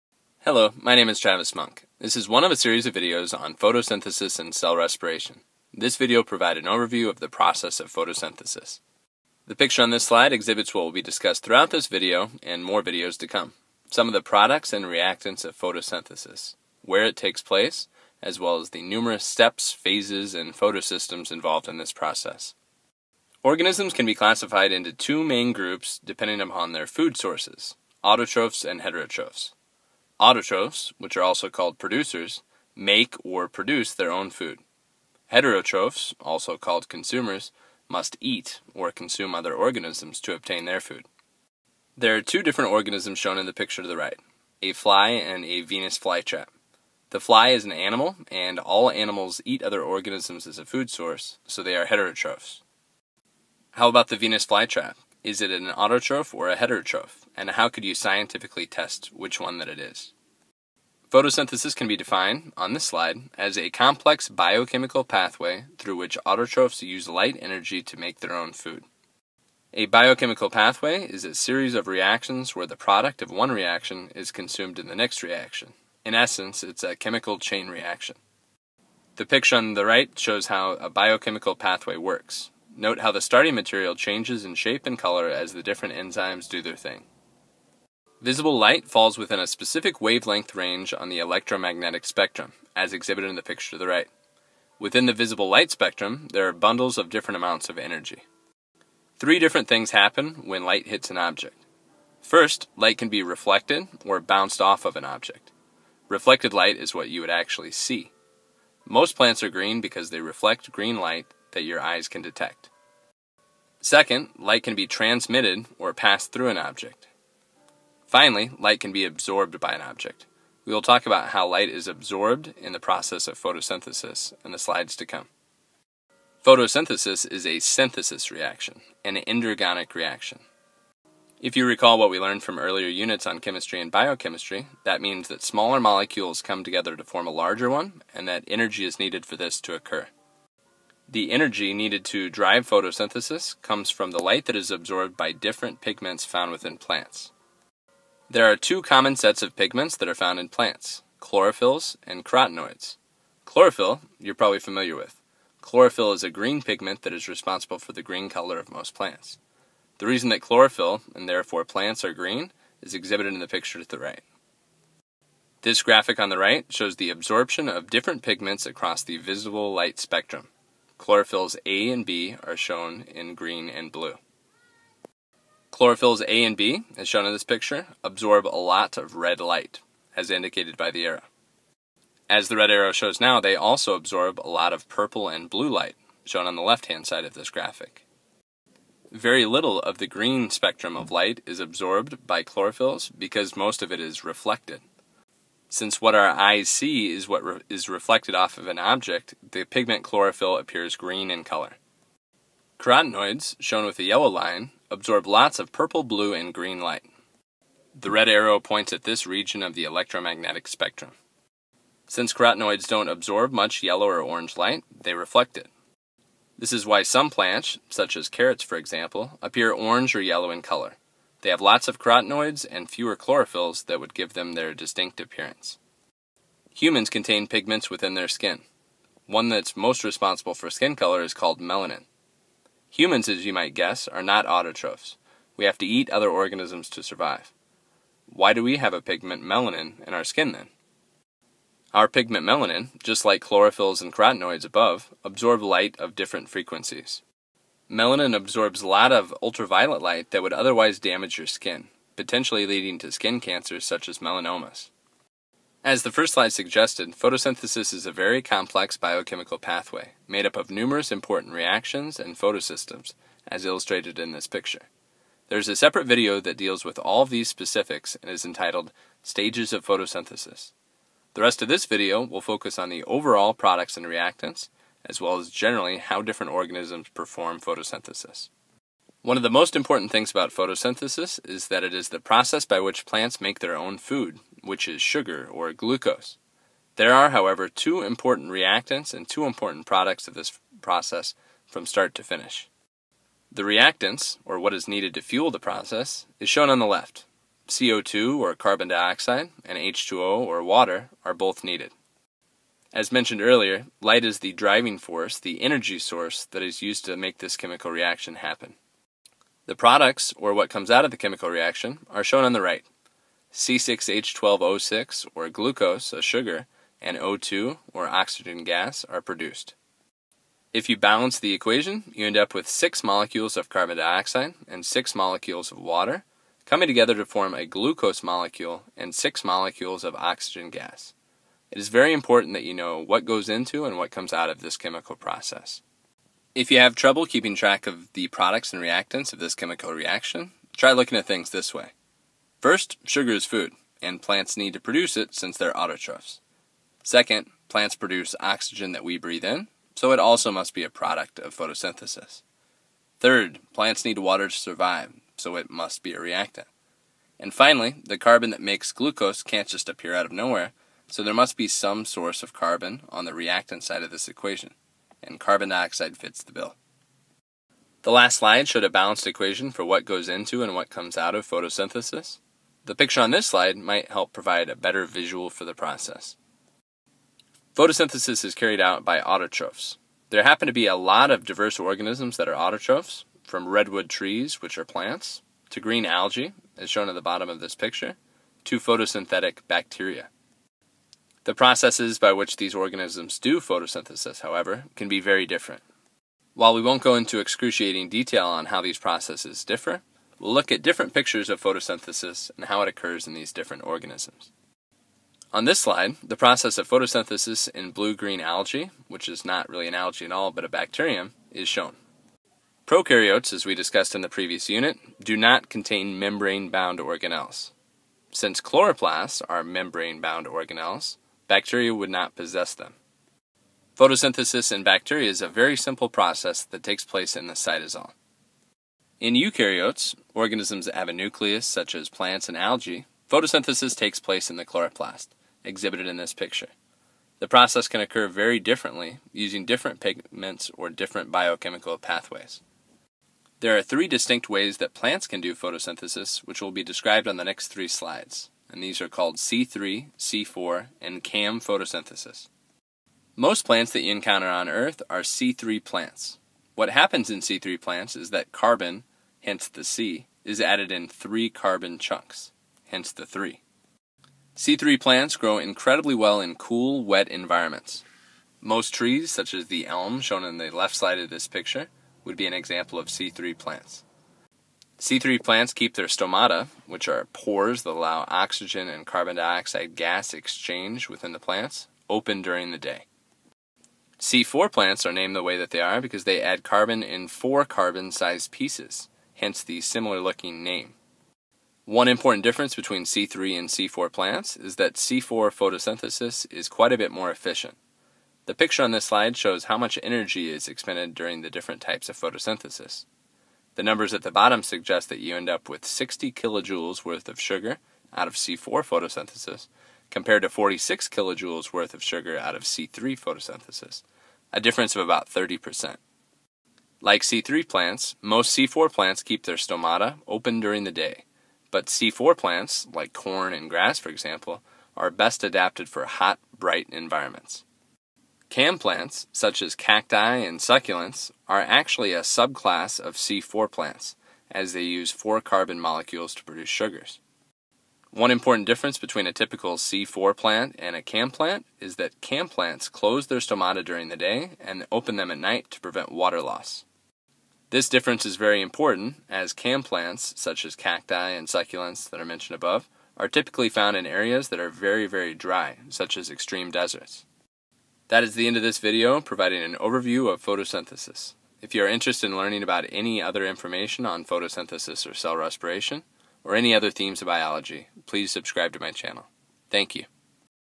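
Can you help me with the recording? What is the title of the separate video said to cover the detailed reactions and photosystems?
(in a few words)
Stages of Photosynthesis.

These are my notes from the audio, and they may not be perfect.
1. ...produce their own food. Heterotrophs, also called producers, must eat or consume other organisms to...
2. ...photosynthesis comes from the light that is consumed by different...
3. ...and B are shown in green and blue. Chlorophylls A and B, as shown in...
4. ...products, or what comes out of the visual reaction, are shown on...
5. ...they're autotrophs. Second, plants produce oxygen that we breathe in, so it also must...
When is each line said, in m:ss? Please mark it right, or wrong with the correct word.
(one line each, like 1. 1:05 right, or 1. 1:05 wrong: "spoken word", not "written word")
1. 0:33 wrong: "consumers", not "producers"
2. 2:22 wrong: "absorbed", not "consumed"
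3. 2:51 right
4. 5:09 wrong: "chemical", not "visual"
5. 5:45 right.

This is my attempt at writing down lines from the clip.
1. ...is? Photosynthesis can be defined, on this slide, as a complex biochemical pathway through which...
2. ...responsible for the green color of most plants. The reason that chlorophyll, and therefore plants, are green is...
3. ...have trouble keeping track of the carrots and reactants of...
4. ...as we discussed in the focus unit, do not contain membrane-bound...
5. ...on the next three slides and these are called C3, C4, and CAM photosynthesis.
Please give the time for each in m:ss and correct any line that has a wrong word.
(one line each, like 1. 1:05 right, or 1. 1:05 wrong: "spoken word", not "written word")
1. 0:59 right
2. 2:37 right
3. 5:36 wrong: "products", not "carrots"
4. 6:53 wrong: "previous", not "focus"
5. 7:27 right.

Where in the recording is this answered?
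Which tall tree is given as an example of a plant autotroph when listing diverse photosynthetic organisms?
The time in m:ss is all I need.
6:23.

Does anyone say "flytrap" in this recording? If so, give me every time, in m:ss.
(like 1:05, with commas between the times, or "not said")
0:45, 0:54.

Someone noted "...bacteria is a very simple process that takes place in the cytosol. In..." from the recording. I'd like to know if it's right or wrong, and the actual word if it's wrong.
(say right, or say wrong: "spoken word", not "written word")
right.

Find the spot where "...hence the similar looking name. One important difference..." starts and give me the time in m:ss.
8:09.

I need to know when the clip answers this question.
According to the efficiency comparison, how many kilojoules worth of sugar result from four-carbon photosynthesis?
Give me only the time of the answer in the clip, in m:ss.
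8:25.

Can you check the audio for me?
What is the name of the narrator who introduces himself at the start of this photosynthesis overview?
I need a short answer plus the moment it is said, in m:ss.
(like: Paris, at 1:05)
Travis Monk, at 0:01.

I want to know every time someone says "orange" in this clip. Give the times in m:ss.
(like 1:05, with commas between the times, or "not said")
3:34, 3:39.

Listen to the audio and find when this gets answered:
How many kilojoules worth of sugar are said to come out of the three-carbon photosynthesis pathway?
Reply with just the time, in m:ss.
8:30.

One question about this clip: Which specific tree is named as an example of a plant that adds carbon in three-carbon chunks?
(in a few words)
elm.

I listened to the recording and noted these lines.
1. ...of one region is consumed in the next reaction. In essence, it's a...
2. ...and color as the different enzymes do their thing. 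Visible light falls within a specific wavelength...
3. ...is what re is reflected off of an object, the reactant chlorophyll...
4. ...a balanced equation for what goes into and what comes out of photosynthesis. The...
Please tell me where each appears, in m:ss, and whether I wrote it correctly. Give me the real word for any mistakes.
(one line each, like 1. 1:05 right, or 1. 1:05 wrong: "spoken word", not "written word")
1. 1:13 wrong: "reaction", not "region"
2. 1:24 right
3. 3:17 wrong: "pigment", not "reactant"
4. 6:08 right.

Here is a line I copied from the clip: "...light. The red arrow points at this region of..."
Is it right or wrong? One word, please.
right.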